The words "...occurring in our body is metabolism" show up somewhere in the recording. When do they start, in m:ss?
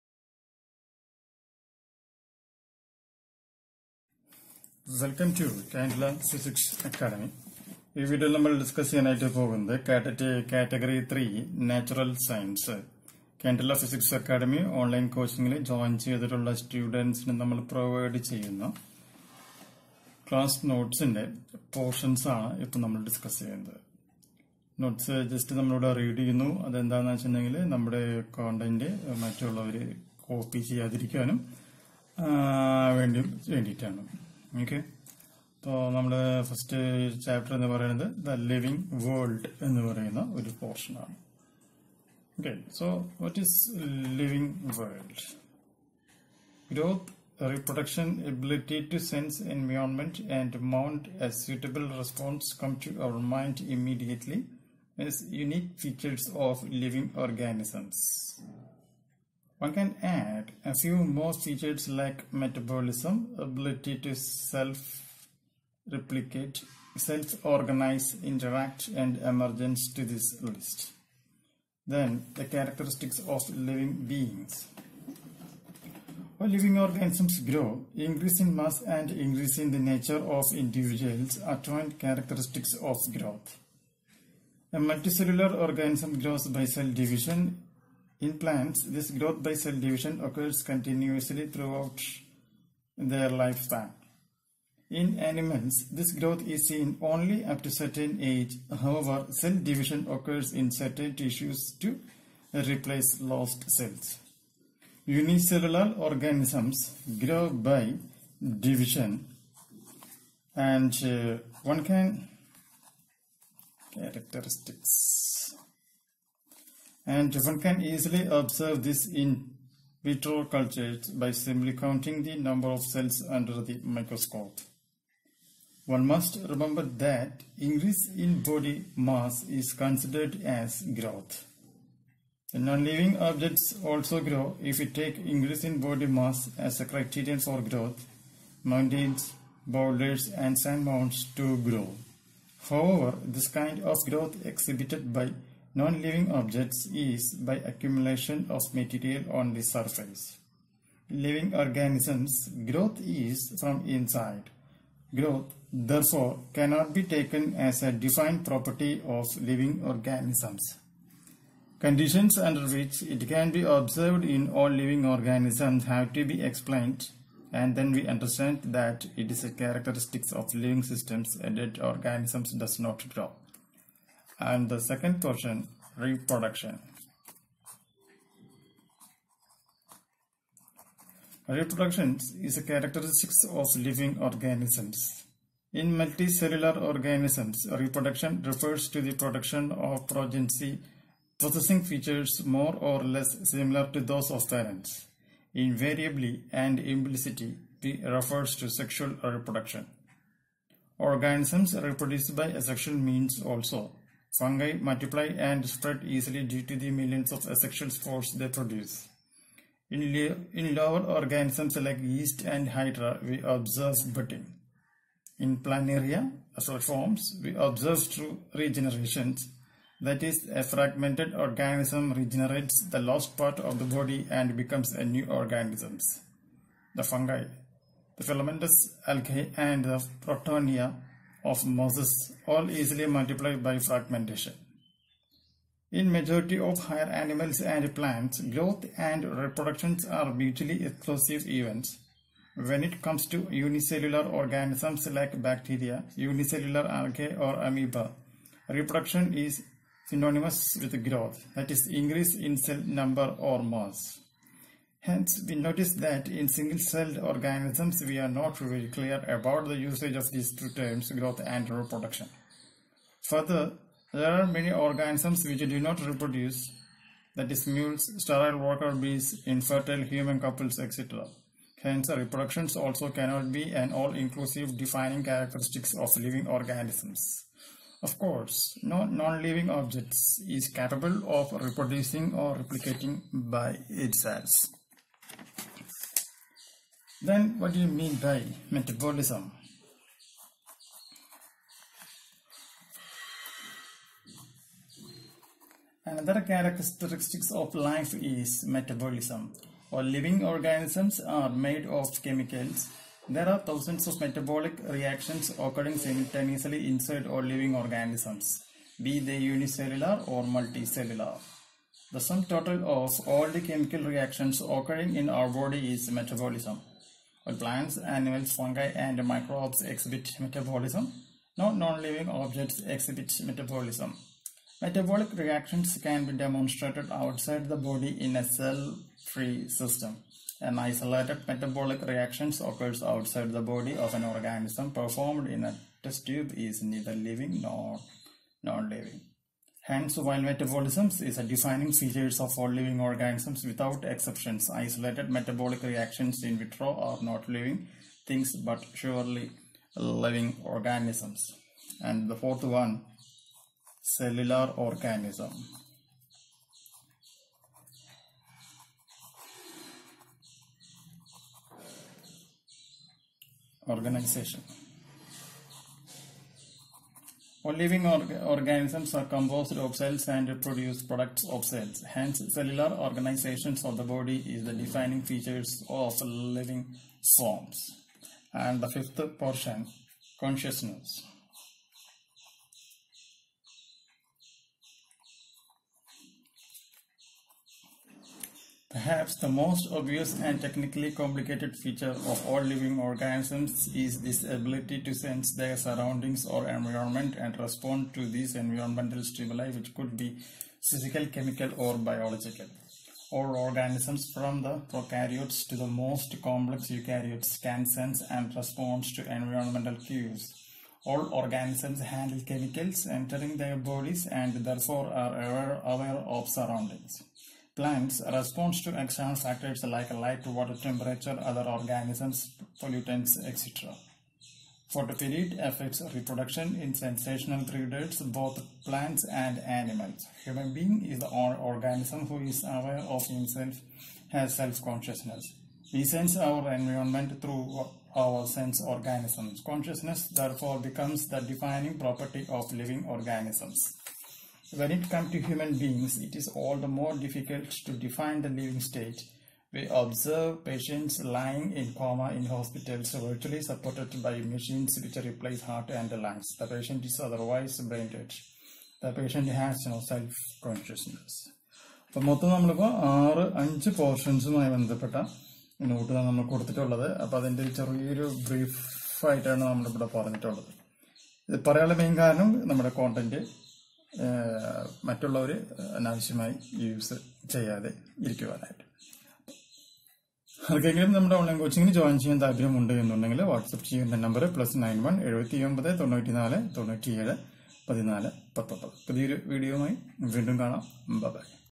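5:14.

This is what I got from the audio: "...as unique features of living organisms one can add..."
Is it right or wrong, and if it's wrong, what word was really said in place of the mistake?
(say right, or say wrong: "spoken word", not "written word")
right.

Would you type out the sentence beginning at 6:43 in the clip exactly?
All organisms from the prokaryotes to the most complex eukaryotes can sense and respond to environmental cues.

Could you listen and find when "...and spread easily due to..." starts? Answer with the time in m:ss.
3:25.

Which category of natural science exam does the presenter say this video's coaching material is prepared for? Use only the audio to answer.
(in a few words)
Category 3.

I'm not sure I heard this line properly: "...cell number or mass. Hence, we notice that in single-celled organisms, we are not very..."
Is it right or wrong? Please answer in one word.
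right.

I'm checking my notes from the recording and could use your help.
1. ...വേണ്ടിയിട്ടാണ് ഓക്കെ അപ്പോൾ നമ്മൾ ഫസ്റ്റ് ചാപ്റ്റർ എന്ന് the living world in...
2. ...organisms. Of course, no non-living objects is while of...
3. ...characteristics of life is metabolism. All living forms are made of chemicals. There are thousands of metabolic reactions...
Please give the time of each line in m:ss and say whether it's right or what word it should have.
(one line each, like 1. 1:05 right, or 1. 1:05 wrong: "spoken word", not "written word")
1. 0:33 right
2. 4:36 wrong: "capable", not "while"
3. 4:56 wrong: "organisms", not "forms".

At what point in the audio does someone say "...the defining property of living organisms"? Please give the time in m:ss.
7:21.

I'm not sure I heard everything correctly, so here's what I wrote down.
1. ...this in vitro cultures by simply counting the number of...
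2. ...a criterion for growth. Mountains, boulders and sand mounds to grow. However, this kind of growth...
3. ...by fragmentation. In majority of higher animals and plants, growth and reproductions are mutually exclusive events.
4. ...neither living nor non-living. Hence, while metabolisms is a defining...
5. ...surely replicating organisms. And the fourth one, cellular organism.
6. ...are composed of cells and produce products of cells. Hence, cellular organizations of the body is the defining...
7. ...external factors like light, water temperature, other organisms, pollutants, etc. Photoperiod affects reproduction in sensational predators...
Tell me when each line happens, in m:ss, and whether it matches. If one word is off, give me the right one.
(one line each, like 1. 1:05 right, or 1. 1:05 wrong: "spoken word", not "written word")
1. 1:58 right
2. 2:16 right
3. 3:53 right
4. 5:36 right
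5. 5:48 wrong: "living", not "replicating"
6. 6:09 right
7. 6:59 right.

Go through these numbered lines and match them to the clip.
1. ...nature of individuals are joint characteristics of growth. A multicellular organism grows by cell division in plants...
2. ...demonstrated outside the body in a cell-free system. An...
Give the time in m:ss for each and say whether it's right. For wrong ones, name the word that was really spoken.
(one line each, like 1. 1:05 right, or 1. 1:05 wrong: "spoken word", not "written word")
1. 1:19 right
2. 5:26 right.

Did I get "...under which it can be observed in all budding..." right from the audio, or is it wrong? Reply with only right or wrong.
wrong.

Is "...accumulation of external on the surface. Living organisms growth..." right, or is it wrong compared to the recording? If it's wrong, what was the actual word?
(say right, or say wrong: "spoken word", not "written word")
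wrong: "material", not "external".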